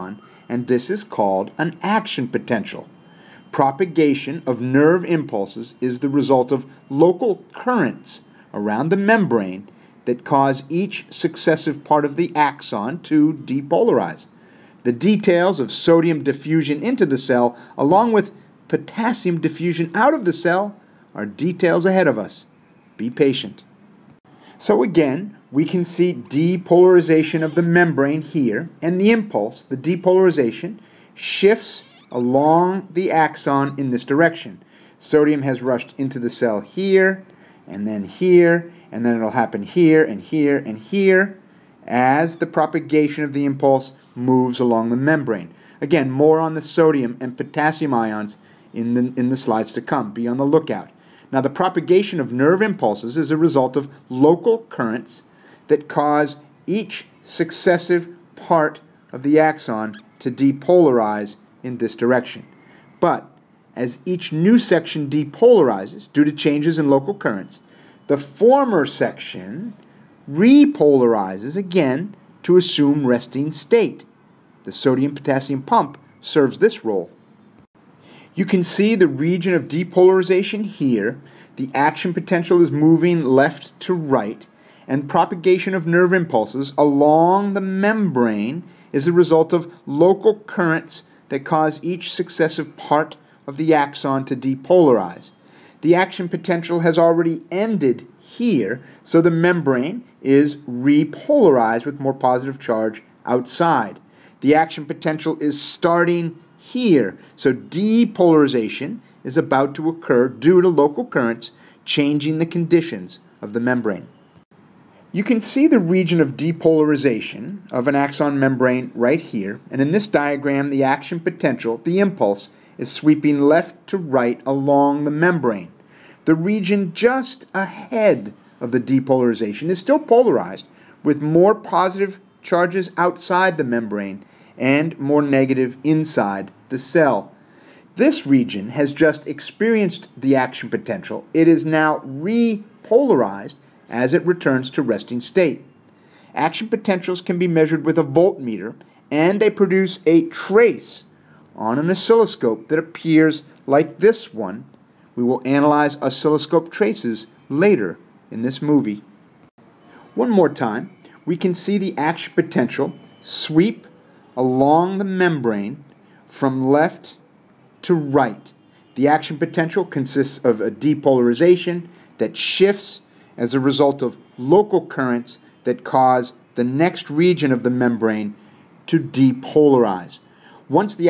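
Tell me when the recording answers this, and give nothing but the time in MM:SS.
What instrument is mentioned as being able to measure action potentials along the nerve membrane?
02:28.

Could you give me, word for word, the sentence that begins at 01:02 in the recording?
But as each new section depolarizes due to changes in local currents, the former section repolarizes again to assume resting state.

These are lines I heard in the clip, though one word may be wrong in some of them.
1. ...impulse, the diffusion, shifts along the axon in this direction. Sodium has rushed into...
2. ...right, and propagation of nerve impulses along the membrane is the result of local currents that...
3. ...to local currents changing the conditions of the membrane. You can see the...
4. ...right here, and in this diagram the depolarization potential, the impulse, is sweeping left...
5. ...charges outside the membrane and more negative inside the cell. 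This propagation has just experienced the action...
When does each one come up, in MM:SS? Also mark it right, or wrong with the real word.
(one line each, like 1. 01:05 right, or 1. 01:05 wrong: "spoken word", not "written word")
1. 00:29 wrong: "depolarization", not "diffusion"
2. 01:23 right
3. 01:50 right
4. 01:58 wrong: "action", not "depolarization"
5. 02:12 wrong: "region", not "propagation".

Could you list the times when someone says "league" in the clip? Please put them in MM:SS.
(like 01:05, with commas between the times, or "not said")
not said.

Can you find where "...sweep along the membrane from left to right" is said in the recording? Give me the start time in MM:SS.
02:43.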